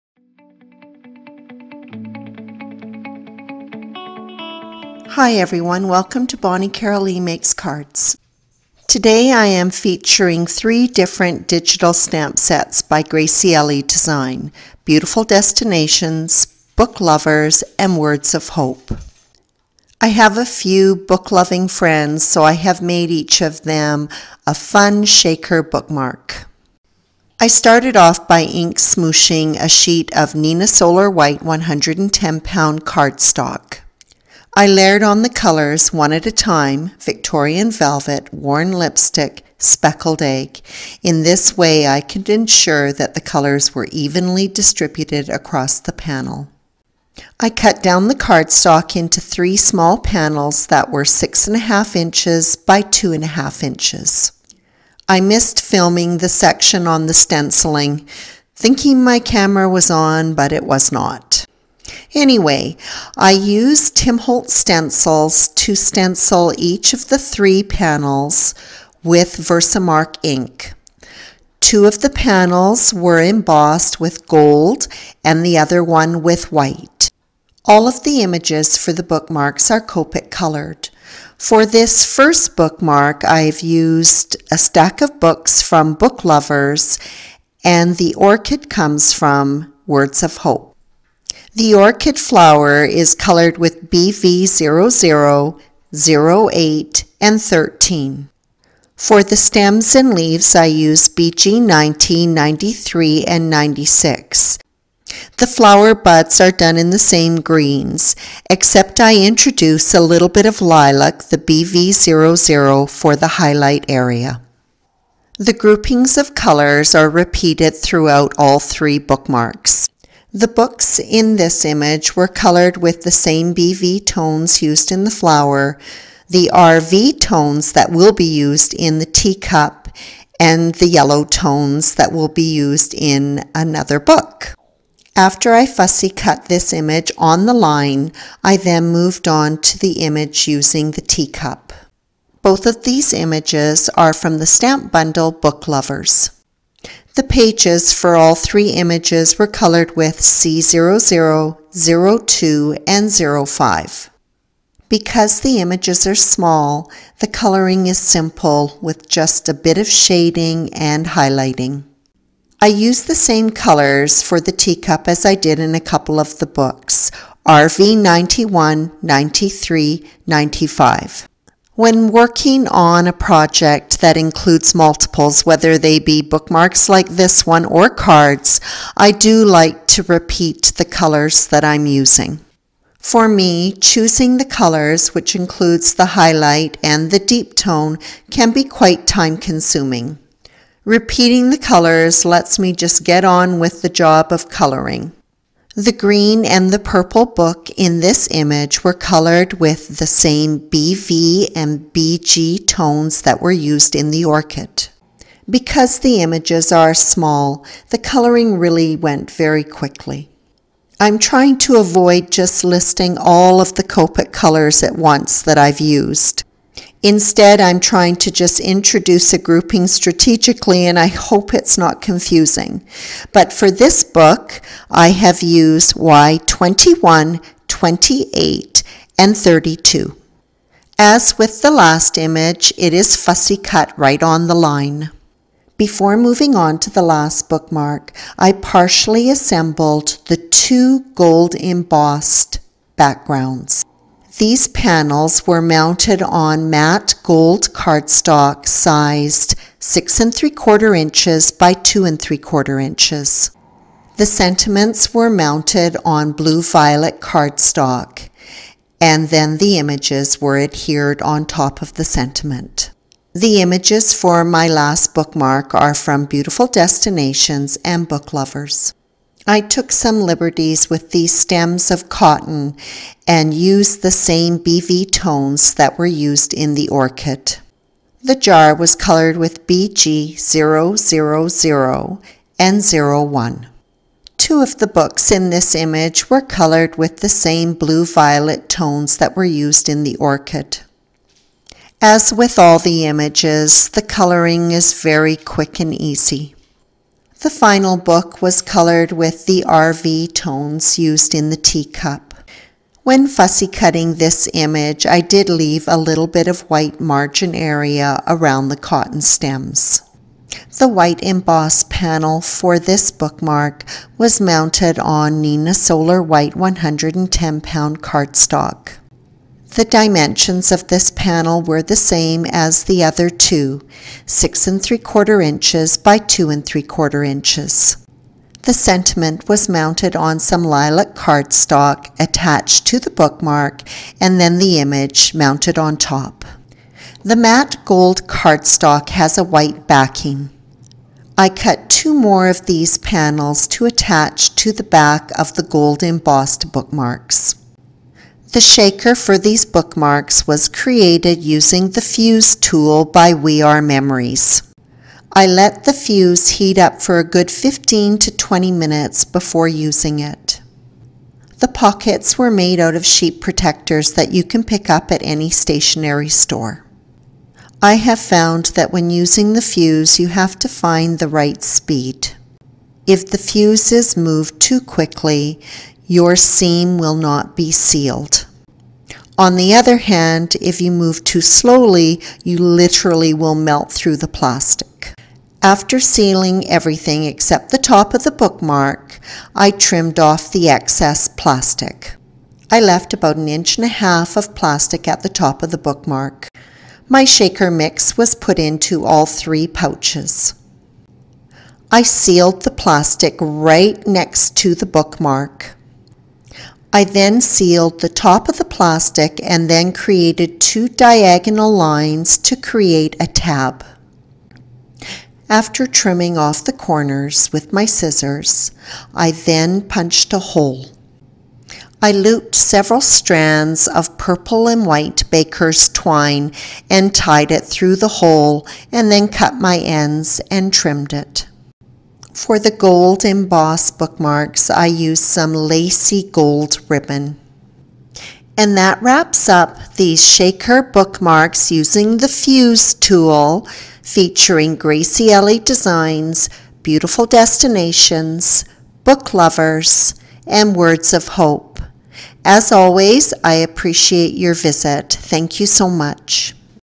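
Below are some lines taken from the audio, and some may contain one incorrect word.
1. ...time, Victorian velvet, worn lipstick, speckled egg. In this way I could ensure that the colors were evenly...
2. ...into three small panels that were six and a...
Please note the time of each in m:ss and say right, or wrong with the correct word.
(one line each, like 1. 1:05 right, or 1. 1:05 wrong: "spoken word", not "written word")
1. 0:36 right
2. 0:48 right.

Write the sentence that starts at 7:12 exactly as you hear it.
For the gold embossed bookmarks, I used some lacy gold ribbon.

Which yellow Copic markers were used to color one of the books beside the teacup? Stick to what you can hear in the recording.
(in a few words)
Y21, 28, and 32.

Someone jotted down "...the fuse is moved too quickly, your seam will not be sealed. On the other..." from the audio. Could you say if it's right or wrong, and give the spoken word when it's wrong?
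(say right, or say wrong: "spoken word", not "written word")
right.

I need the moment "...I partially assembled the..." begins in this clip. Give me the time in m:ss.
3:58.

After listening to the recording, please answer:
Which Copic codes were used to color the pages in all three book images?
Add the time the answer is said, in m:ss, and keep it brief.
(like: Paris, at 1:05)
C00, 02, and 05, at 2:30.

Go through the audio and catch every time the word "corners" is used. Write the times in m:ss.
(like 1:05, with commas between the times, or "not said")
6:56.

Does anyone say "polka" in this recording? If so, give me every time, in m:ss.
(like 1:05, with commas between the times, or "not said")
not said.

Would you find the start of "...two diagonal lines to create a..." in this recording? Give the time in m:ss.
6:50.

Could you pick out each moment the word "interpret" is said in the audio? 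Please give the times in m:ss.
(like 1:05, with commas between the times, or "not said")
not said.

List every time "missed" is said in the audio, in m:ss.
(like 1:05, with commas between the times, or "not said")
0:55.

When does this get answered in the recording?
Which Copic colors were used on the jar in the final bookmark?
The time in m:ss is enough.
4:39.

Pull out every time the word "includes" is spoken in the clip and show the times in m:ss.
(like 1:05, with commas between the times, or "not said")
2:54, 3:05.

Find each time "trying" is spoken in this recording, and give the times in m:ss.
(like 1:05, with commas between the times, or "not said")
3:31, 3:37.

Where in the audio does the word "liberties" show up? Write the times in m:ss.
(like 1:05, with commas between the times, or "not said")
4:30.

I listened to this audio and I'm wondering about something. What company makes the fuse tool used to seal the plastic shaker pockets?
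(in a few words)
We R Memories.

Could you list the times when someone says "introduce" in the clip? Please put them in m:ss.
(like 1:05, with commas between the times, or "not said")
1:49, 3:38.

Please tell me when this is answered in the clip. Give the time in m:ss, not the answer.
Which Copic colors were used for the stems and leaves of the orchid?
1:41.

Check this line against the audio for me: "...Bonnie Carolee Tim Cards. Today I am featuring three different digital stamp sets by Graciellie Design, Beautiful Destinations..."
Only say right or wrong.
wrong.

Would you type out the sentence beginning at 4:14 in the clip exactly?
The sentiments were mounted on blue-violet cardstock and then the images were adhered on top of the sentiment.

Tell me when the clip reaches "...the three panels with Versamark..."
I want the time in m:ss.
1:07.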